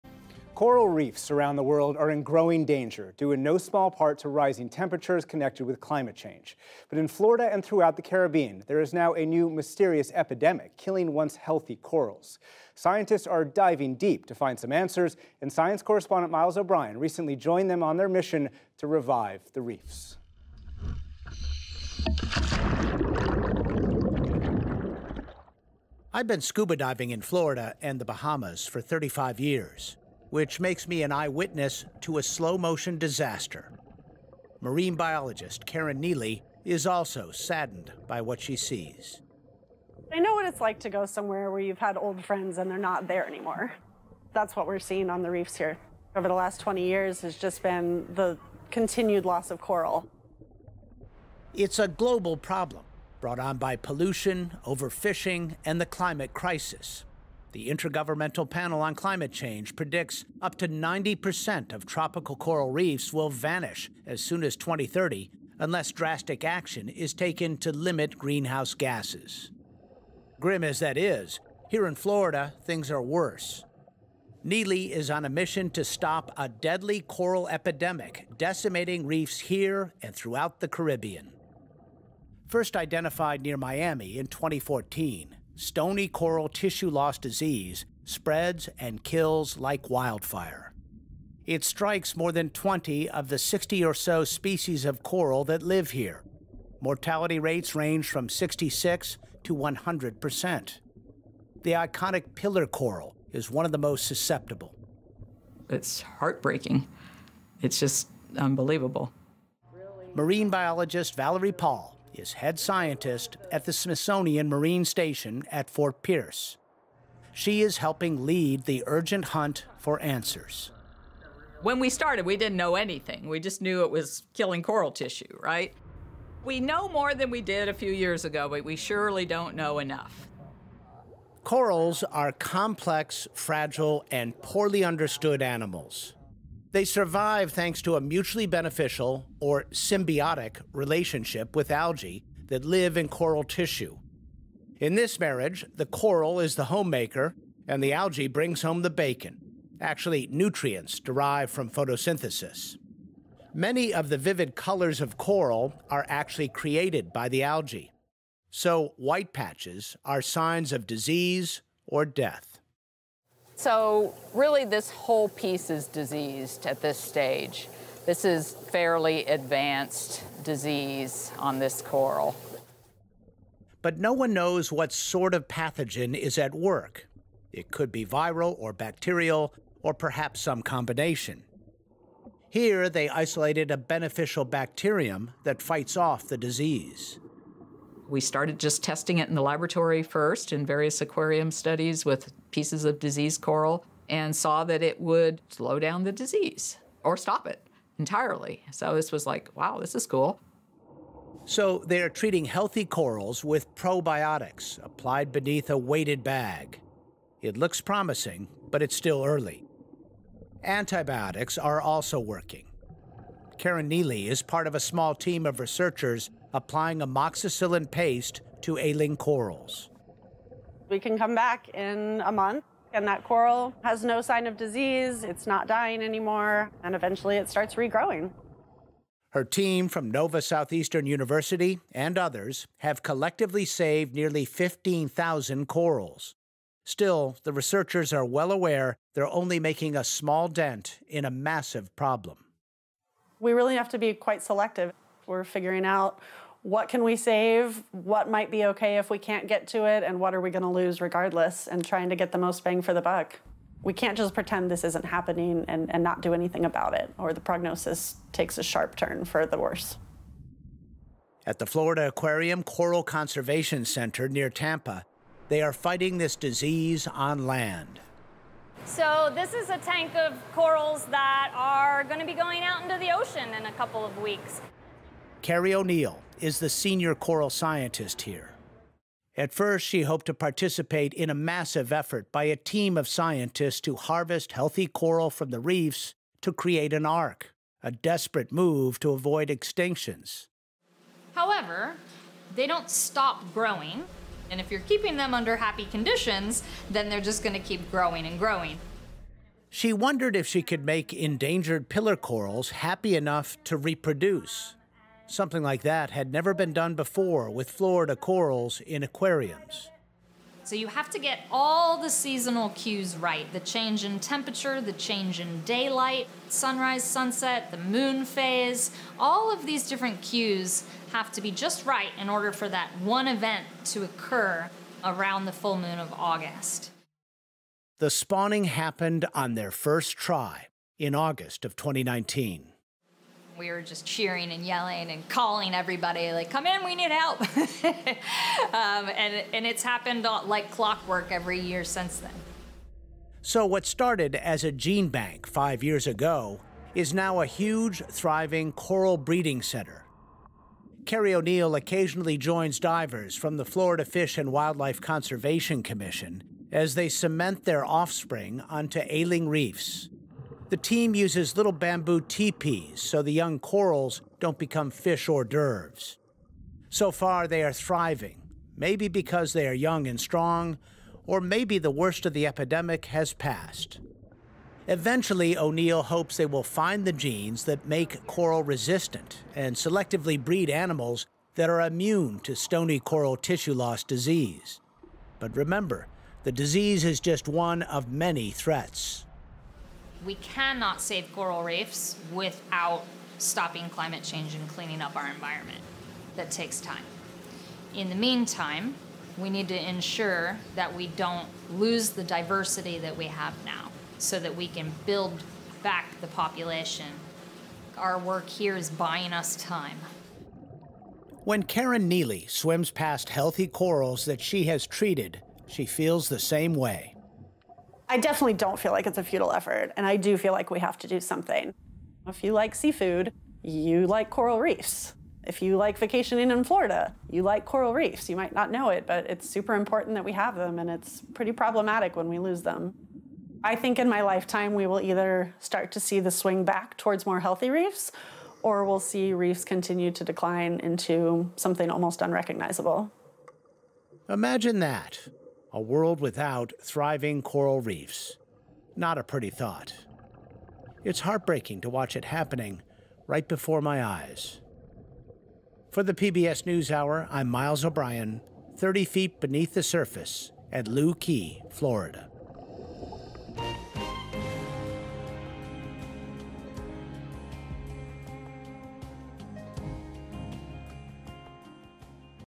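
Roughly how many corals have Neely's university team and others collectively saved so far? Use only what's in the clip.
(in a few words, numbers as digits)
15,000.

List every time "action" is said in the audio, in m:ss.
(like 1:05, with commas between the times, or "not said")
1:06.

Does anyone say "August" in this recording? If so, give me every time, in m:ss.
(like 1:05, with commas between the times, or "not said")
5:26, 5:31.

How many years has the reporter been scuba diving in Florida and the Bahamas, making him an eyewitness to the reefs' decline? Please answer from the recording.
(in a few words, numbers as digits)
35.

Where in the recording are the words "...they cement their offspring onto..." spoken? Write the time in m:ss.
5:56.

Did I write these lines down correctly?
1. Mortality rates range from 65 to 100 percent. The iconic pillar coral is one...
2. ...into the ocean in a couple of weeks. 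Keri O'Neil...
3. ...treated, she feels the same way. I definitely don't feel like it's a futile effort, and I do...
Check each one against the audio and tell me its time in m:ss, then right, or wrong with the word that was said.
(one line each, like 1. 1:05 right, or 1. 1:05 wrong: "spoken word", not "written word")
1. 1:36 wrong: "66", not "65"
2. 4:32 right
3. 6:54 right.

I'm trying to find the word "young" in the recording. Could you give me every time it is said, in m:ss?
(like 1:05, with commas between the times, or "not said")
6:03, 6:09.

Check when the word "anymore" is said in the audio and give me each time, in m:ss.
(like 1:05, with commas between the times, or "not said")
0:43, 3:46.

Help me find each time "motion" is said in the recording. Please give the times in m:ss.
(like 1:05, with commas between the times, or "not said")
0:32.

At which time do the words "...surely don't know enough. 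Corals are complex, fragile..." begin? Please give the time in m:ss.
2:08.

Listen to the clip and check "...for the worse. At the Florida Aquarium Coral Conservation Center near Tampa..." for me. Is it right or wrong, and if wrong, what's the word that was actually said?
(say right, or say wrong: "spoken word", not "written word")
right.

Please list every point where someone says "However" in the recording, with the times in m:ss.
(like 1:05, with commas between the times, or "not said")
4:51.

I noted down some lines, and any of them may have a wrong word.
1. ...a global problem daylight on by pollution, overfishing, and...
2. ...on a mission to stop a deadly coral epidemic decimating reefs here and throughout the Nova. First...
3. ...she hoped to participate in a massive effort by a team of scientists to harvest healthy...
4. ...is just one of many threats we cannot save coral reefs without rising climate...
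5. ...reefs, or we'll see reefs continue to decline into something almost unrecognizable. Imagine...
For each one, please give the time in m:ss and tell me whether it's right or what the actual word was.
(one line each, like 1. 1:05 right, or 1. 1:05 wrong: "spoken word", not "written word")
1. 0:51 wrong: "brought", not "daylight"
2. 1:15 wrong: "Caribbean", not "Nova"
3. 4:39 right
4. 6:27 wrong: "stopping", not "rising"
5. 7:17 right.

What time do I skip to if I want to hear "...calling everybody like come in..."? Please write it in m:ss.
5:35.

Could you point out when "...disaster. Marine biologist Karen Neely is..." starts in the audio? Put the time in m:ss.
0:32.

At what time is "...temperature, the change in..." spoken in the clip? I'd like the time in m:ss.
5:14.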